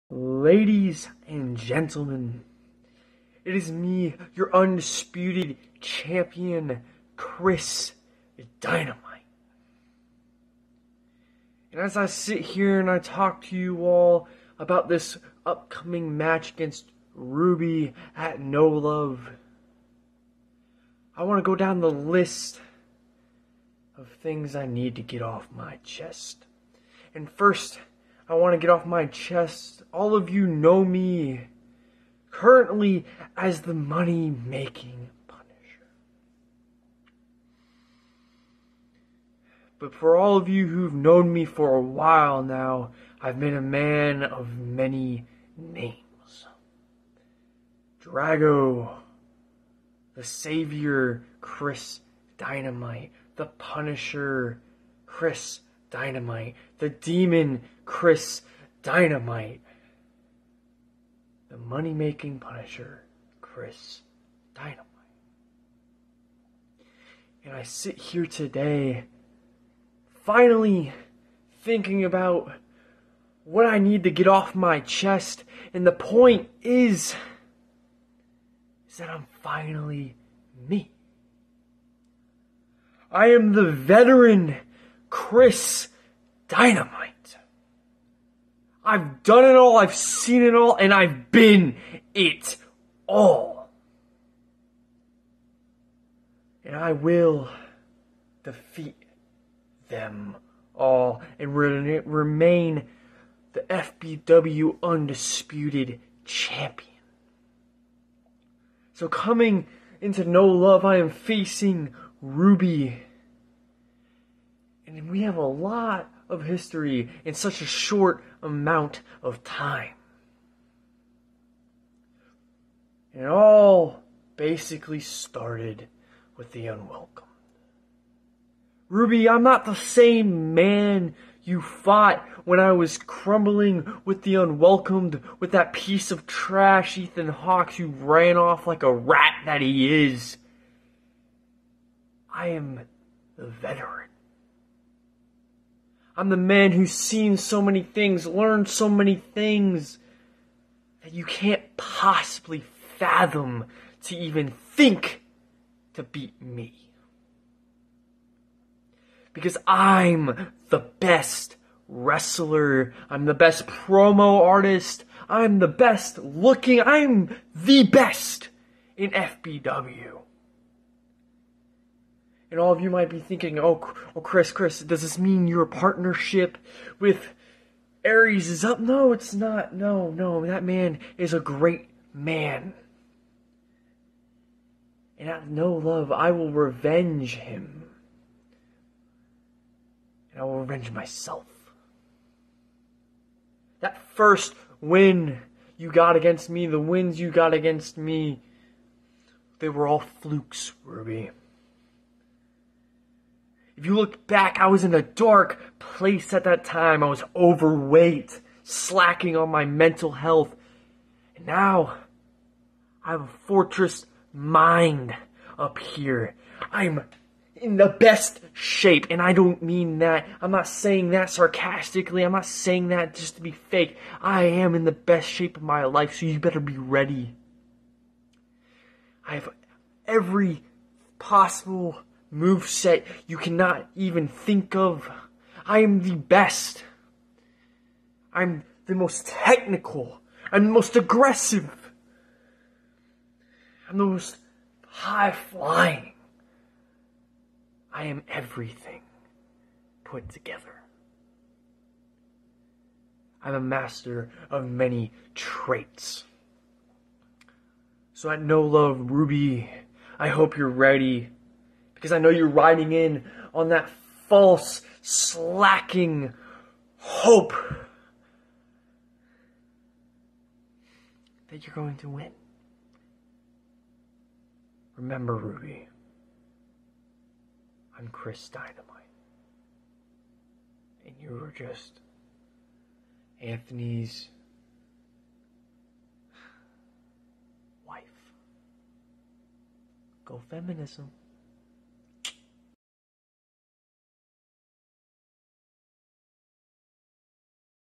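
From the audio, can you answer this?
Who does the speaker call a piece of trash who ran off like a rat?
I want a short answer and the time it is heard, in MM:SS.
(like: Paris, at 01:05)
Ethan Hawke, at 02:16.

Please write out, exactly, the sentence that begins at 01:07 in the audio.
And I sit here today, finally thinking about what I need to get off my chest.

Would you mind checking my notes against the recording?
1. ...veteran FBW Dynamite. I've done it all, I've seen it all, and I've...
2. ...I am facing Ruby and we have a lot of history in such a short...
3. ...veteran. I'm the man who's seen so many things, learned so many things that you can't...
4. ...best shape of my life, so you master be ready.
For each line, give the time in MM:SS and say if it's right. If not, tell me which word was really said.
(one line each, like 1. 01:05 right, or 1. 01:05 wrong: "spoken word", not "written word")
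1. 01:23 wrong: "Chris", not "FBW"
2. 01:50 right
3. 02:23 right
4. 03:44 wrong: "better", not "master".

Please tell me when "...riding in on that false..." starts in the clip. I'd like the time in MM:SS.
04:22.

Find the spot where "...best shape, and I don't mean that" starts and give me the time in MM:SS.
03:37.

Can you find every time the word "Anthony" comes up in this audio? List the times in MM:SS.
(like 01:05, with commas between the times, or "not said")
04:43.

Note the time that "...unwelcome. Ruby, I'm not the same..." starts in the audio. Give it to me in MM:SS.
02:06.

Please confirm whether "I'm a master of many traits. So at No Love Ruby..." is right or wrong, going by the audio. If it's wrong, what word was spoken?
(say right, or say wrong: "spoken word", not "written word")
right.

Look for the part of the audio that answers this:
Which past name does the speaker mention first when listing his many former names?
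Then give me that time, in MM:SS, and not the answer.
00:48.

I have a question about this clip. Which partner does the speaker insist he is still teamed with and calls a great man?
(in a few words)
Aries.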